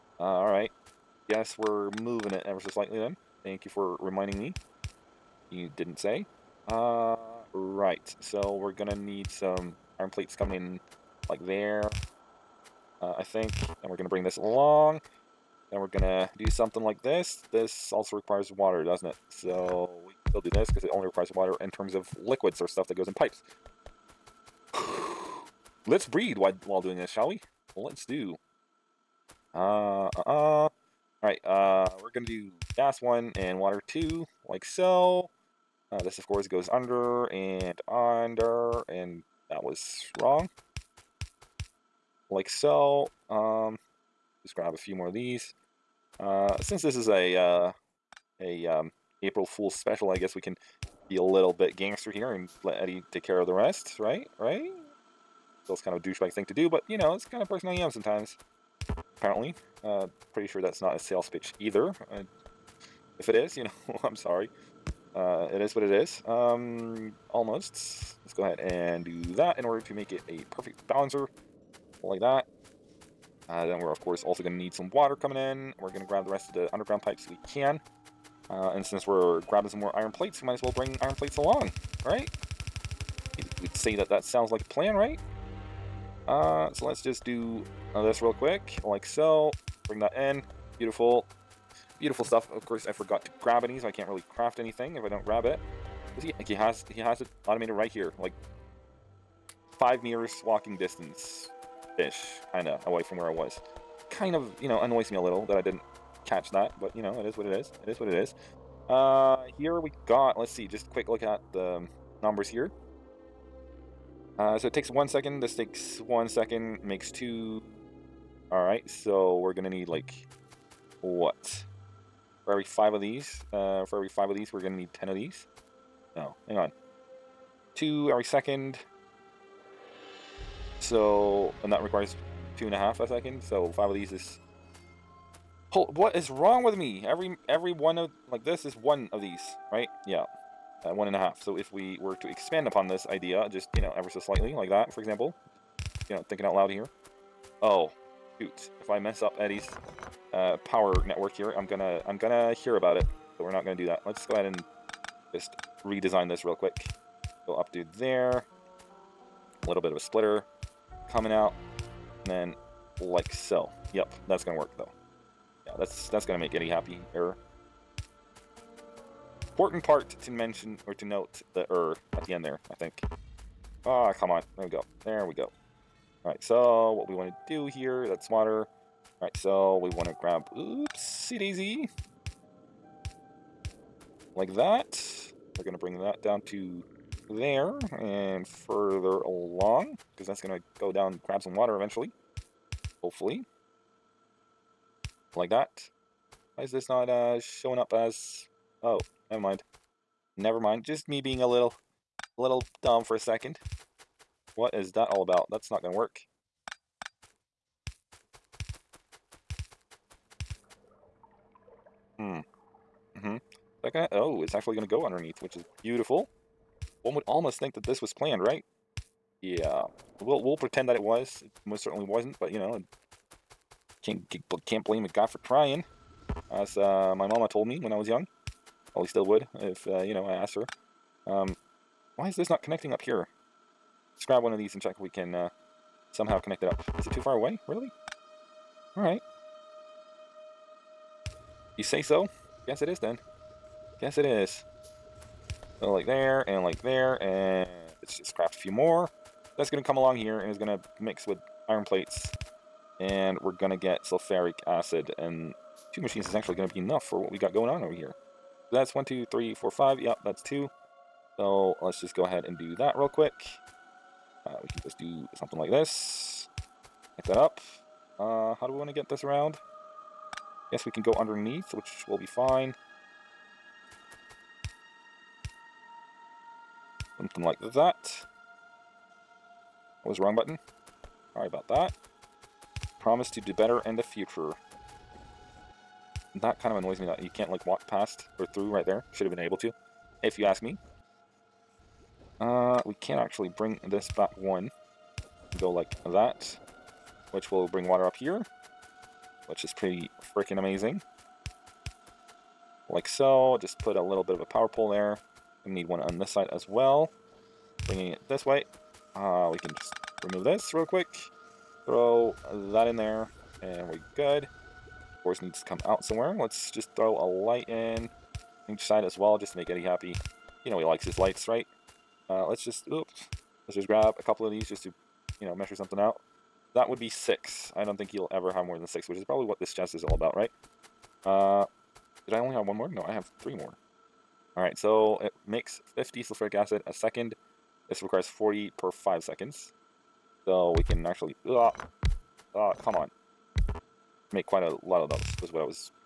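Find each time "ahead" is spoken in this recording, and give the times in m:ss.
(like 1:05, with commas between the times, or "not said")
1:08, 2:34, 4:22.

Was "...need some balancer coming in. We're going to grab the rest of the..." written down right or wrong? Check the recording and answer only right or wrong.
wrong.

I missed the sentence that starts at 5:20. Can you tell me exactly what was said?
You know he likes his lights, right?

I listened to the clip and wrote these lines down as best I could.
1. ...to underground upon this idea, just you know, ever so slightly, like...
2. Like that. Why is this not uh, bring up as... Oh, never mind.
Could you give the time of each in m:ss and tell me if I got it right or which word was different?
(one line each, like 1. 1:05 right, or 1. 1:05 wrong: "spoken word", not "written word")
1. 2:22 wrong: "expand", not "underground"
2. 3:15 wrong: "showing", not "bring".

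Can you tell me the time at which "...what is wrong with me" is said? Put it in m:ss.
2:15.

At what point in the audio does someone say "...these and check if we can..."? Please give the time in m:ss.
3:54.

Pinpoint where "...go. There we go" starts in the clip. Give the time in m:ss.
2:54.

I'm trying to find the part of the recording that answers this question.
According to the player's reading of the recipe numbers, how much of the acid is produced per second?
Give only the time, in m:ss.
5:35.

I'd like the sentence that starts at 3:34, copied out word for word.
oh, it's actually going to go underneath, which is beautiful.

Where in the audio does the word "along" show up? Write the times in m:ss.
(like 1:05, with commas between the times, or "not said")
0:14, 1:21, 3:09, 4:09.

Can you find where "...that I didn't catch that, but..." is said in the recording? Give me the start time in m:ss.
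1:45.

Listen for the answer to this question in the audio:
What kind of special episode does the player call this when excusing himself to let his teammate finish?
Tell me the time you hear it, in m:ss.
0:49.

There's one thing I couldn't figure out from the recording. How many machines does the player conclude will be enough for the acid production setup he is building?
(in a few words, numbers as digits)
2.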